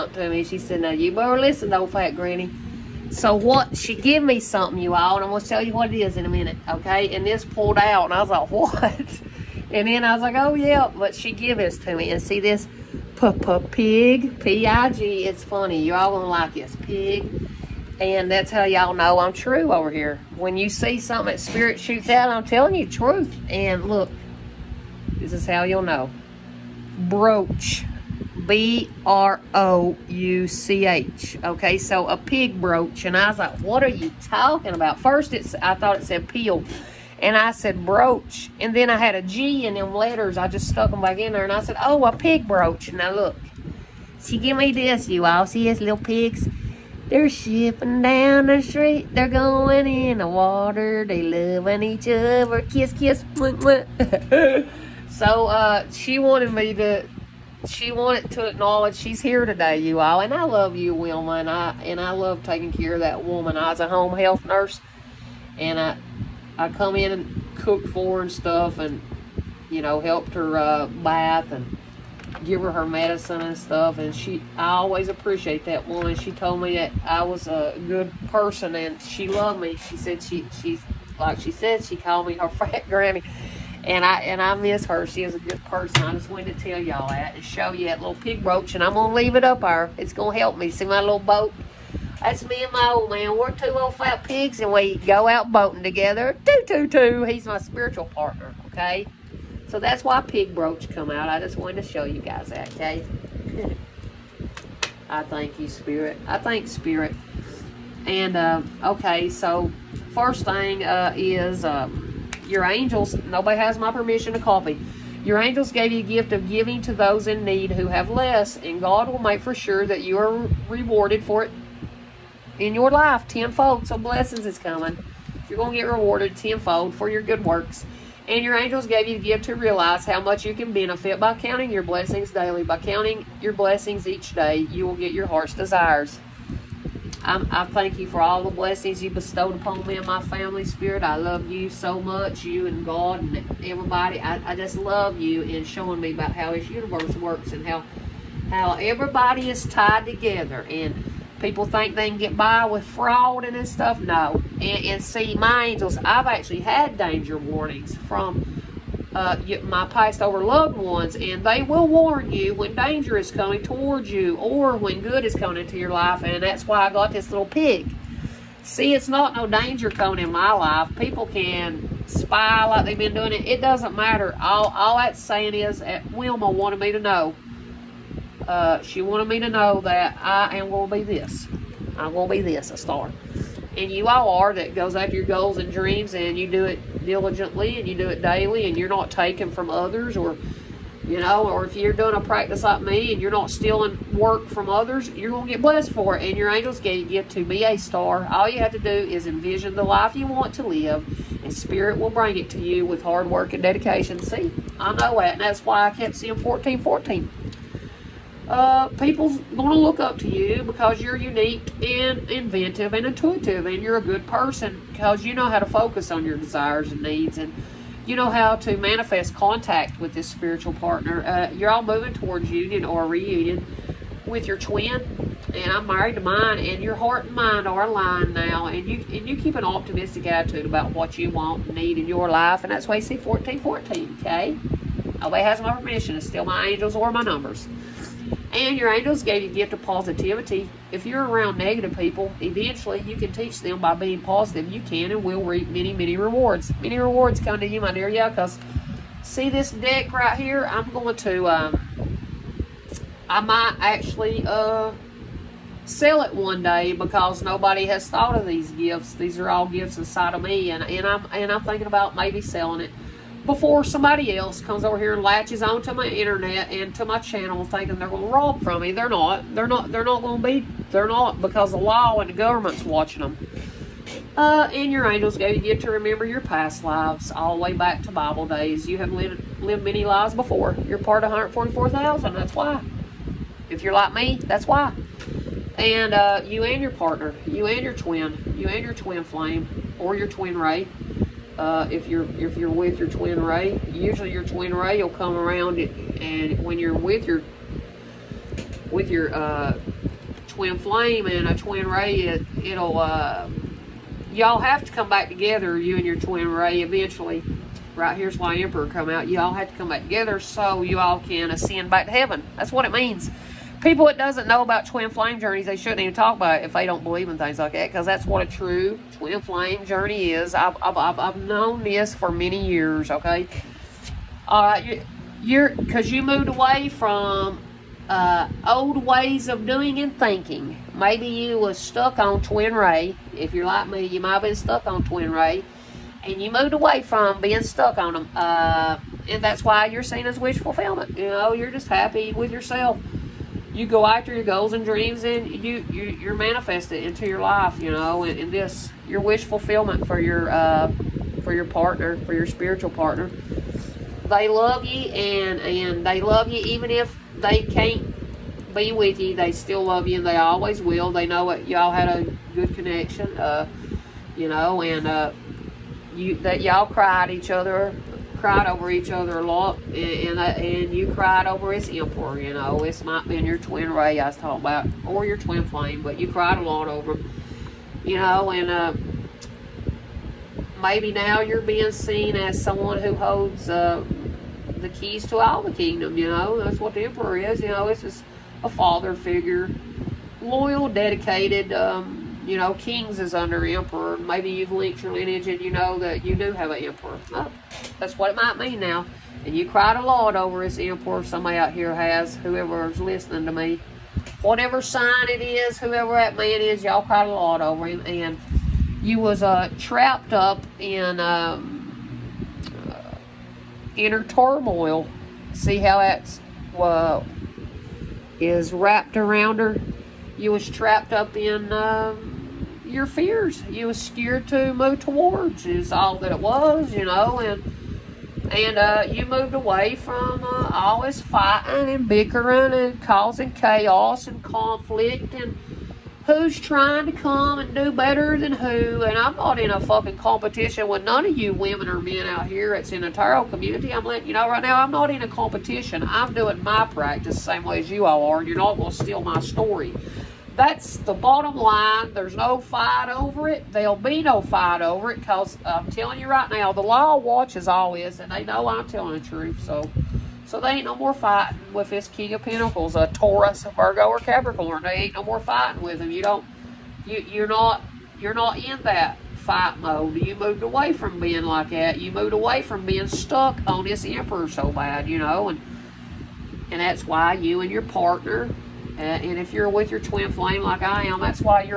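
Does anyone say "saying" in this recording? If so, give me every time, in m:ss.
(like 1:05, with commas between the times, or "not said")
2:55.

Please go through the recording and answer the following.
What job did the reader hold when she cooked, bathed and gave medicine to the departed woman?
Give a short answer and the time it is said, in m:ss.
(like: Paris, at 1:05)
Home health nurse, at 1:03.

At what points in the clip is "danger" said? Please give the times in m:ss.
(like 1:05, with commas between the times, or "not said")
2:36, 2:42, 2:49.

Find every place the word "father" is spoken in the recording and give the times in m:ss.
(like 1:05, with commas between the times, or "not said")
6:28.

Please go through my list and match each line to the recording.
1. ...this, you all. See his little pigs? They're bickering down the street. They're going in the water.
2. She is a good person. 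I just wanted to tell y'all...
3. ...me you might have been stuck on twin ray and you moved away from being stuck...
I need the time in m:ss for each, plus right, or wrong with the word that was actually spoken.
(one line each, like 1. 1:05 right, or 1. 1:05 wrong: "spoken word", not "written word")
1. 0:44 wrong: "shipping", not "bickering"
2. 1:25 right
3. 5:33 right.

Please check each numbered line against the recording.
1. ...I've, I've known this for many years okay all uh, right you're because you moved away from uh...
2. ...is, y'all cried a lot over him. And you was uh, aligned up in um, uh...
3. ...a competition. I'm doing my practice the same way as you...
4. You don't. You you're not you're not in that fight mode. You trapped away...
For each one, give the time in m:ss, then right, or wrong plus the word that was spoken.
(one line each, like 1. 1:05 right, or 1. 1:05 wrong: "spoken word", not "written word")
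1. 5:20 right
2. 6:46 wrong: "trapped", not "aligned"
3. 7:25 right
4. 7:46 wrong: "moved", not "trapped".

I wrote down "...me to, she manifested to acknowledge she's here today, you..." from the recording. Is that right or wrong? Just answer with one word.
wrong.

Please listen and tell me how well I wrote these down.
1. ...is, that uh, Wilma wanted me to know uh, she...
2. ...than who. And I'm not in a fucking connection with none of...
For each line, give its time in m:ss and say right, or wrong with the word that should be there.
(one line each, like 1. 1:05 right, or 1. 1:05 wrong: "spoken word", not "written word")
1. 2:55 right
2. 7:18 wrong: "competition", not "connection".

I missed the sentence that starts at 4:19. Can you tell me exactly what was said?
These are all gifts inside of me.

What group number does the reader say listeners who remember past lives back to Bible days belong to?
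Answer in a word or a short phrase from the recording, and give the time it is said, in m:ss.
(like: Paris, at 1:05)
144,000, at 4:41.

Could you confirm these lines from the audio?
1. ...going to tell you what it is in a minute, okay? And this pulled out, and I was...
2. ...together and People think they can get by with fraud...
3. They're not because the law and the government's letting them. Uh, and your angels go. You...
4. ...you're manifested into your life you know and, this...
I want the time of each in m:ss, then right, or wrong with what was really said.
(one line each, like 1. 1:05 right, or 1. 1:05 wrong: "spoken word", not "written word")
1. 0:05 right
2. 2:30 right
3. 4:30 wrong: "watching", not "letting"
4. 5:46 right.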